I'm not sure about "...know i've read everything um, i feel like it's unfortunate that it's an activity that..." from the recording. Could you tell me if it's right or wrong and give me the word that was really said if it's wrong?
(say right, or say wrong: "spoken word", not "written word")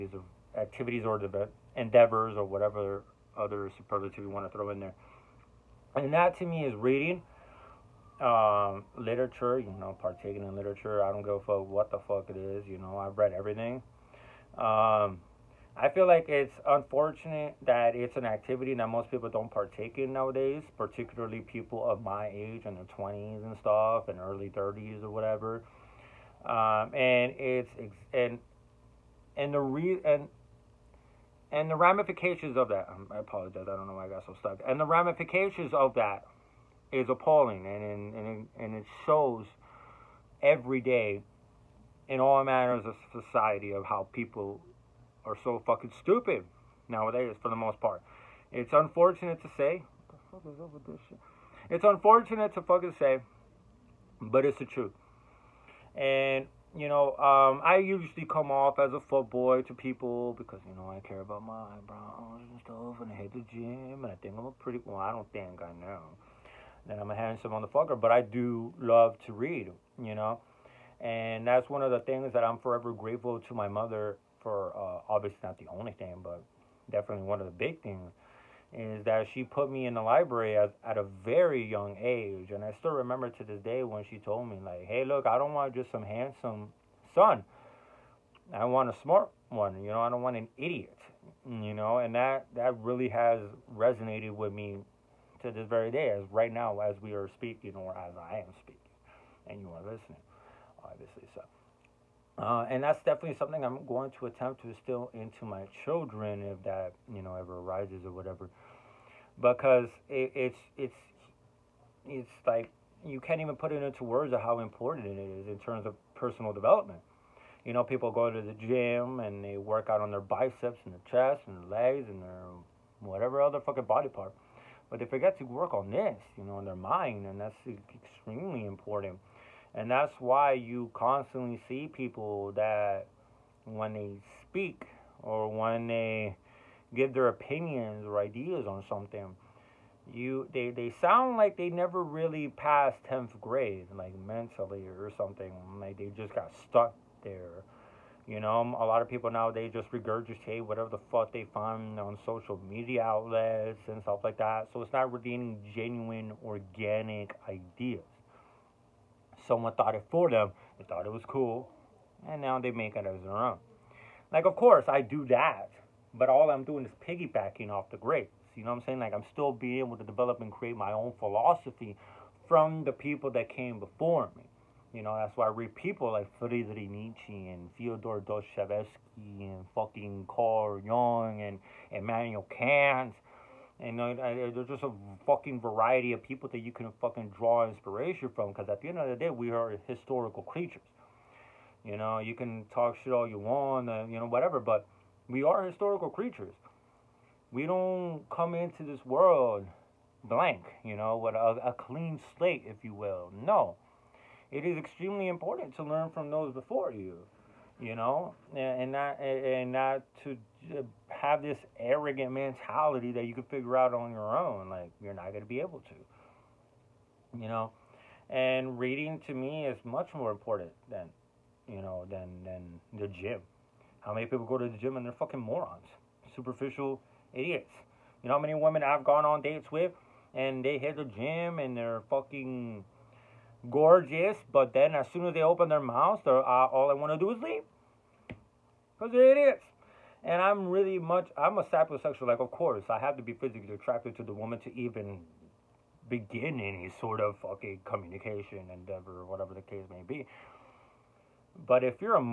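right.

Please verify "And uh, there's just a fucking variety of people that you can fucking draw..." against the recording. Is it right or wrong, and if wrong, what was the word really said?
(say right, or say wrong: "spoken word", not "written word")
right.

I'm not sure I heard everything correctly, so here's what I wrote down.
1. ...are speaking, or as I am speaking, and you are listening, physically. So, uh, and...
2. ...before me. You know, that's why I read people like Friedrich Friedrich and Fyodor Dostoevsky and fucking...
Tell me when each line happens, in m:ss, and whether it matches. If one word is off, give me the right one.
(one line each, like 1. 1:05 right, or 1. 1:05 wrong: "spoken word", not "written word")
1. 1:37 wrong: "obviously", not "physically"
2. 2:53 wrong: "Nietzsche", not "Friedrich".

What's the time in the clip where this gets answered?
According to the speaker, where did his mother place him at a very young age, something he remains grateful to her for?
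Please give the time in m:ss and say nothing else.
1:20.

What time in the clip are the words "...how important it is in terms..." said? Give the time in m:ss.
1:54.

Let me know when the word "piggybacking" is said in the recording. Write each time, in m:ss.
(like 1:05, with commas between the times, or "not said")
2:47.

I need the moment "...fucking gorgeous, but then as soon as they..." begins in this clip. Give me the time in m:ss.
3:52.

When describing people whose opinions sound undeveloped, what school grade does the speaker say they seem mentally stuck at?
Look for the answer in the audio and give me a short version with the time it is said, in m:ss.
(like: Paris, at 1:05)
10th grade, at 2:23.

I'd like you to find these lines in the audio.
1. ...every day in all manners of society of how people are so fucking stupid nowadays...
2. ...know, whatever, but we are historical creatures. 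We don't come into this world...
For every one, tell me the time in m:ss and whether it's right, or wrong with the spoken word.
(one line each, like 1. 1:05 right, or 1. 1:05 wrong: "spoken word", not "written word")
1. 0:40 right
2. 3:14 right.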